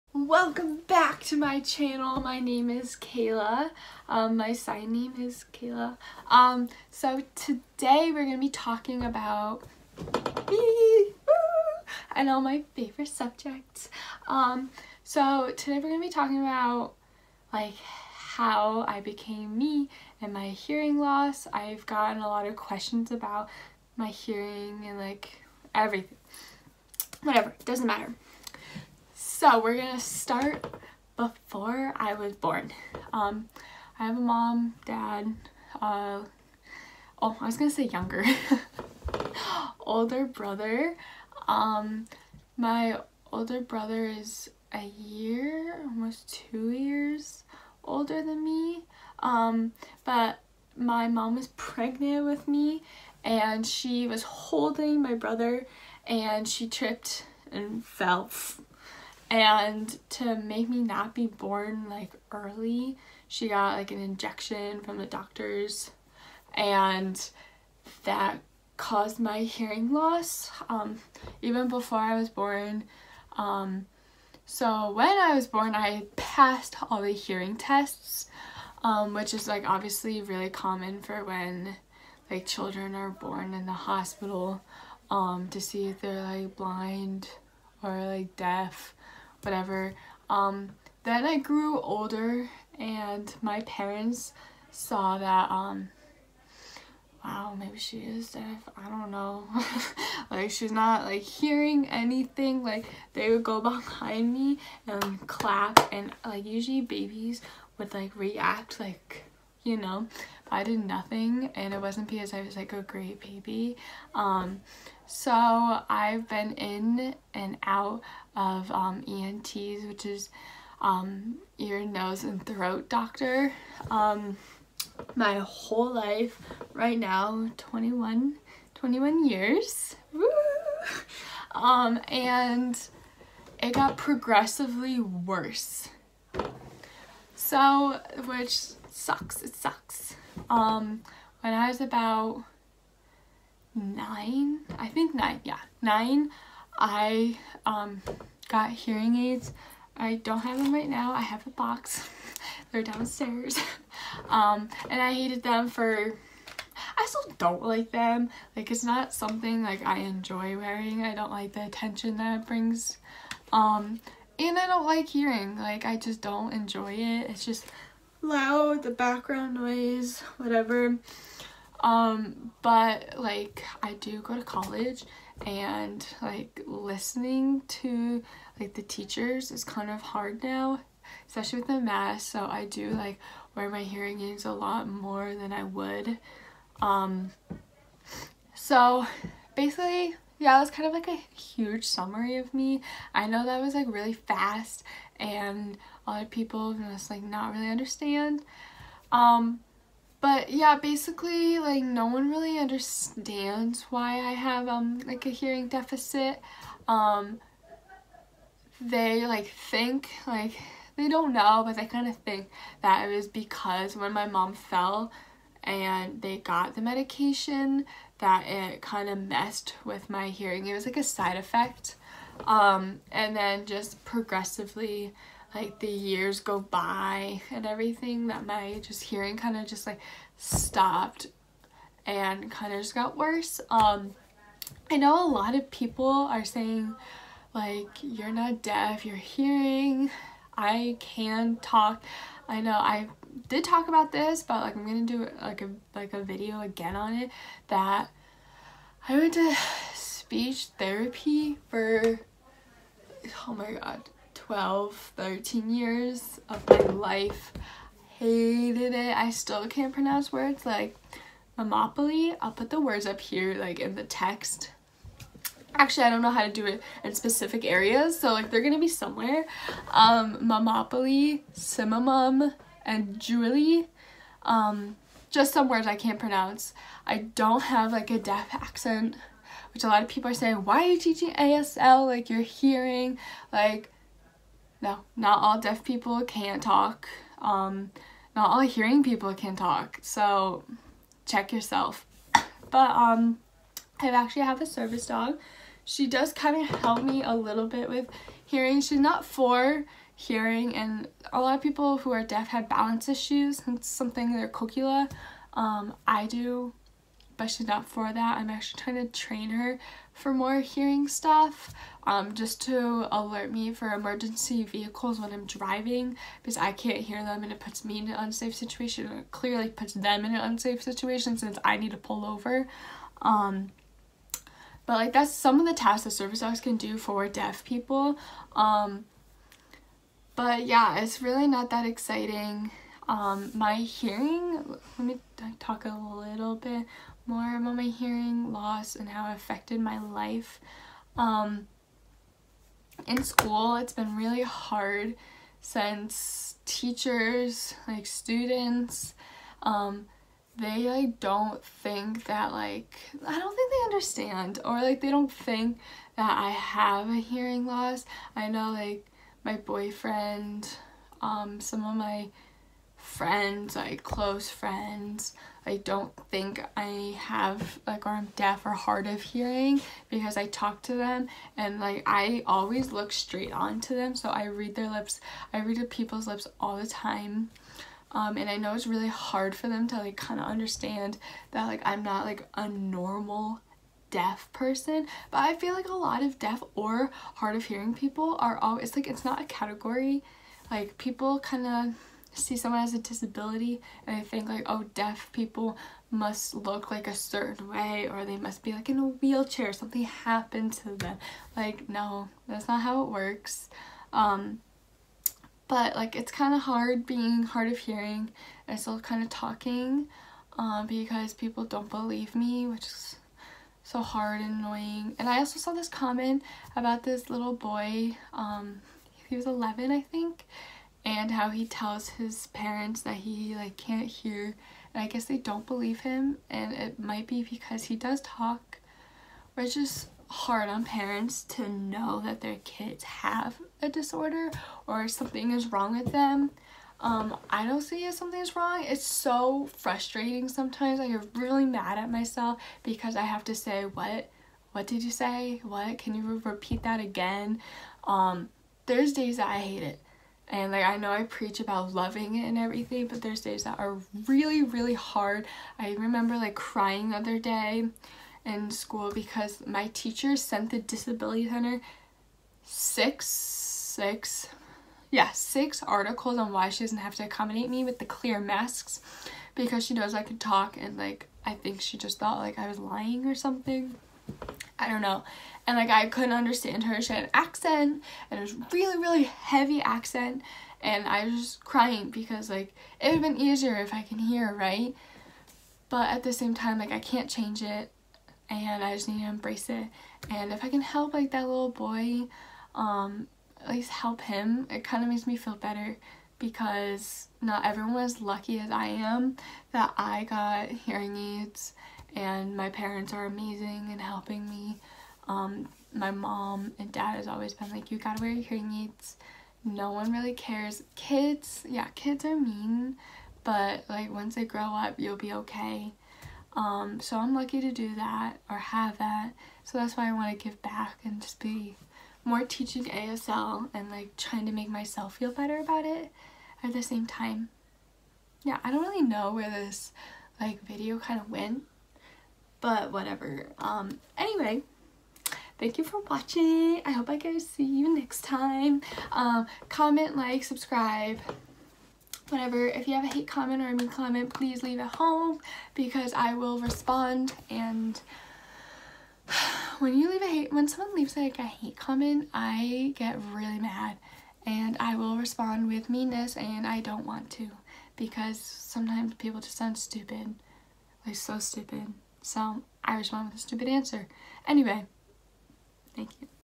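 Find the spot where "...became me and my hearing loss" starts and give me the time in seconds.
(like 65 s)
19 s.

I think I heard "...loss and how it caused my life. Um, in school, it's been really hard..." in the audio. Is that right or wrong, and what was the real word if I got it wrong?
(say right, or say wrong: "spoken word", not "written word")
wrong: "affected", not "caused".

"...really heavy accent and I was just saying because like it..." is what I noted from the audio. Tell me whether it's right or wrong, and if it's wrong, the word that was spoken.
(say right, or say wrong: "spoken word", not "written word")
wrong: "crying", not "saying".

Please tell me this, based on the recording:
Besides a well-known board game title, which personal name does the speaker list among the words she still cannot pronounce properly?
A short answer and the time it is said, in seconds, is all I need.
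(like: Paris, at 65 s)
Julie, at 273 s.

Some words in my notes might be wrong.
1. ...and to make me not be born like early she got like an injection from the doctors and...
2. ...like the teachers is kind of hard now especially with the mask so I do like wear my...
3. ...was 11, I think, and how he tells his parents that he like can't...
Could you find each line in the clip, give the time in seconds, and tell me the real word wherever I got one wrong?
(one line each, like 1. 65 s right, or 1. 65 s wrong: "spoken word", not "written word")
1. 59 s right
2. 178 s right
3. 419 s right.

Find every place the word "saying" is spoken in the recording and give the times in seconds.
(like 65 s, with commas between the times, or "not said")
236 s, 280 s.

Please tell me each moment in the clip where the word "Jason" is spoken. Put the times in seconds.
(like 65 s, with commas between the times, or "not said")
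not said.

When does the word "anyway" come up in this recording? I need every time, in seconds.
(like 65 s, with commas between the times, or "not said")
534 s, 564 s.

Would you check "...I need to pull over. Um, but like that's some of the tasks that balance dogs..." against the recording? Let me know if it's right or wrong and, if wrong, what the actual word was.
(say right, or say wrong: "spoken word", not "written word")
wrong: "service", not "balance".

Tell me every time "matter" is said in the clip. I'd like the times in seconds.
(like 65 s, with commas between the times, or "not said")
27 s.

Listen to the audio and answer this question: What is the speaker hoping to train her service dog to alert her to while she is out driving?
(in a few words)
Emergency vehicles.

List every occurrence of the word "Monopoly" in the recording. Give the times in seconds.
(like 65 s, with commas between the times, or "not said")
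261 s, 270 s.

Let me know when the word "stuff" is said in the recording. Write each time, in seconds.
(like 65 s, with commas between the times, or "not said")
311 s.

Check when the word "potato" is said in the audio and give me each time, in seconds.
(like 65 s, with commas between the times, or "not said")
not said.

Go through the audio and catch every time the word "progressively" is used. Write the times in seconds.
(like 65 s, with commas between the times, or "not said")
133 s, 224 s.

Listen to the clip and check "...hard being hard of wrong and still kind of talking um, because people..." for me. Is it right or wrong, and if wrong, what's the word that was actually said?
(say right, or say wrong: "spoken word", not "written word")
wrong: "hearing", not "wrong".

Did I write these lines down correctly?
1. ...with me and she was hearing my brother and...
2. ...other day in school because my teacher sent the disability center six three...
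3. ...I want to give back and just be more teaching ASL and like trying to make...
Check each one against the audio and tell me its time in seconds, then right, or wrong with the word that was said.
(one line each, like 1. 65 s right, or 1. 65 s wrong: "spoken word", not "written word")
1. 52 s wrong: "holding", not "hearing"
2. 457 s wrong: "six", not "three"
3. 520 s right.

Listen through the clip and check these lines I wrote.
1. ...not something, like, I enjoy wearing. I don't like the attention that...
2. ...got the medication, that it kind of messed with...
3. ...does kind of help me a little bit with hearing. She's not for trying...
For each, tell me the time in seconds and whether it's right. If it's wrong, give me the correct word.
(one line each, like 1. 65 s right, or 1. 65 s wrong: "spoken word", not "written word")
1. 158 s right
2. 216 s right
3. 296 s wrong: "hearing", not "trying".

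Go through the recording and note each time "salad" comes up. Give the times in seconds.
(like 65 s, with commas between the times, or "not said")
not said.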